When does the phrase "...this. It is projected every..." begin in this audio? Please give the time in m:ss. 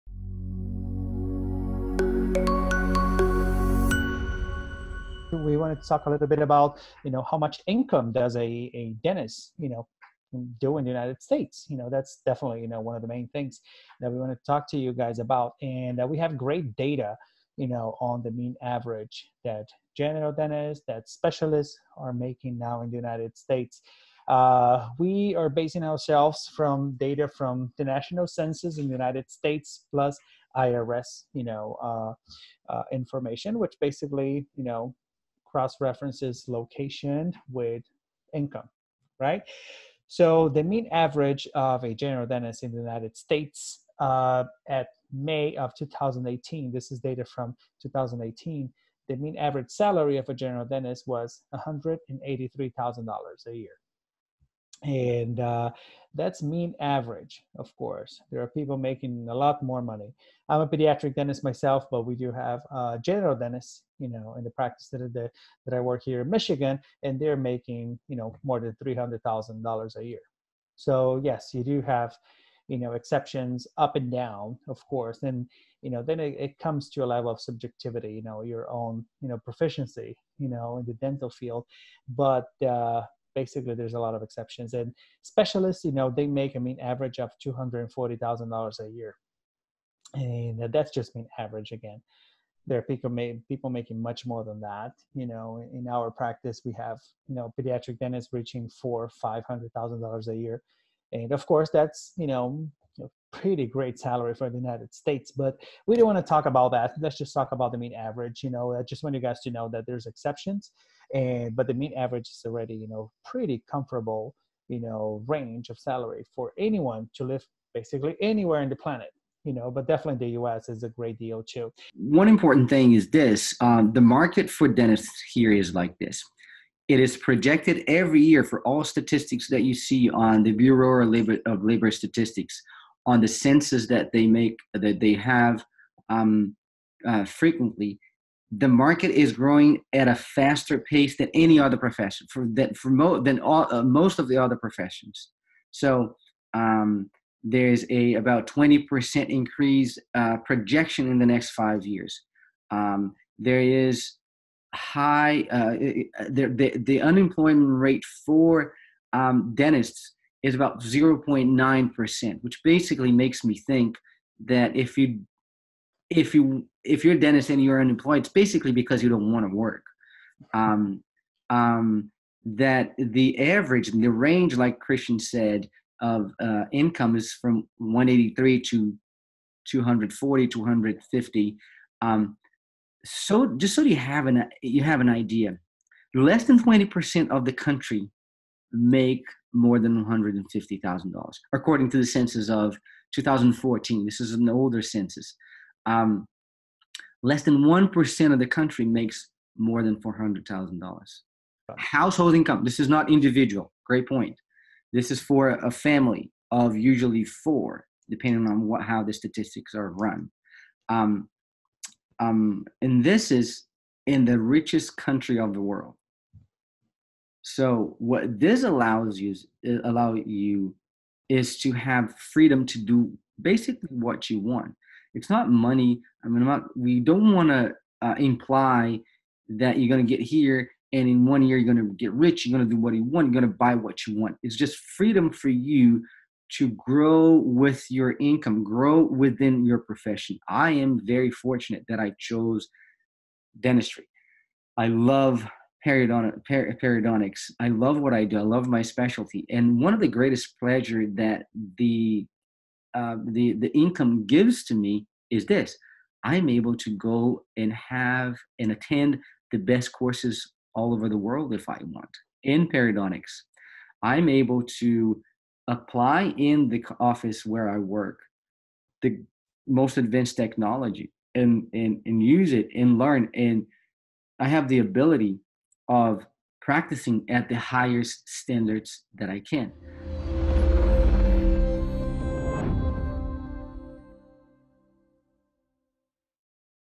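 2:05.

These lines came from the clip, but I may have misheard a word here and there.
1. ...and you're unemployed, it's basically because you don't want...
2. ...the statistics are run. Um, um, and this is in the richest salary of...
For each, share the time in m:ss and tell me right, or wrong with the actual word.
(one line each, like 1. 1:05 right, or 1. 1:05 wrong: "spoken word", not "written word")
1. 2:47 right
2. 3:29 wrong: "country", not "salary".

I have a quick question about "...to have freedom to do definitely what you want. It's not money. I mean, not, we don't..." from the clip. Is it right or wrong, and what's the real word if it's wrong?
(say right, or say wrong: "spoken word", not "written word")
wrong: "basically", not "definitely".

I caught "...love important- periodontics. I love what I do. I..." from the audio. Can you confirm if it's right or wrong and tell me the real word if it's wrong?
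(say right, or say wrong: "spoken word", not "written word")
wrong: "periodont", not "important".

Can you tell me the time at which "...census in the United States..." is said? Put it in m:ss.
0:28.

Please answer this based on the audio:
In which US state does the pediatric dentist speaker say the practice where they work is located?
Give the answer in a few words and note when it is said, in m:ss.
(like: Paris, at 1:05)
Michigan, at 1:06.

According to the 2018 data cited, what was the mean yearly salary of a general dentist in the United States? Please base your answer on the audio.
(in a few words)
$183,000.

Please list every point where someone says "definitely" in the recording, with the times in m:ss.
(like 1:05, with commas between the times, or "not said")
0:12, 1:59.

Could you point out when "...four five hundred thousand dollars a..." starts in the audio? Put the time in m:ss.
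1:38.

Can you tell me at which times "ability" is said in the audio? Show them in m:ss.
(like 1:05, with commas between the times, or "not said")
4:34.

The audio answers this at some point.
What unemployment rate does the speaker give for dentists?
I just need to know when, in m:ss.
2:40.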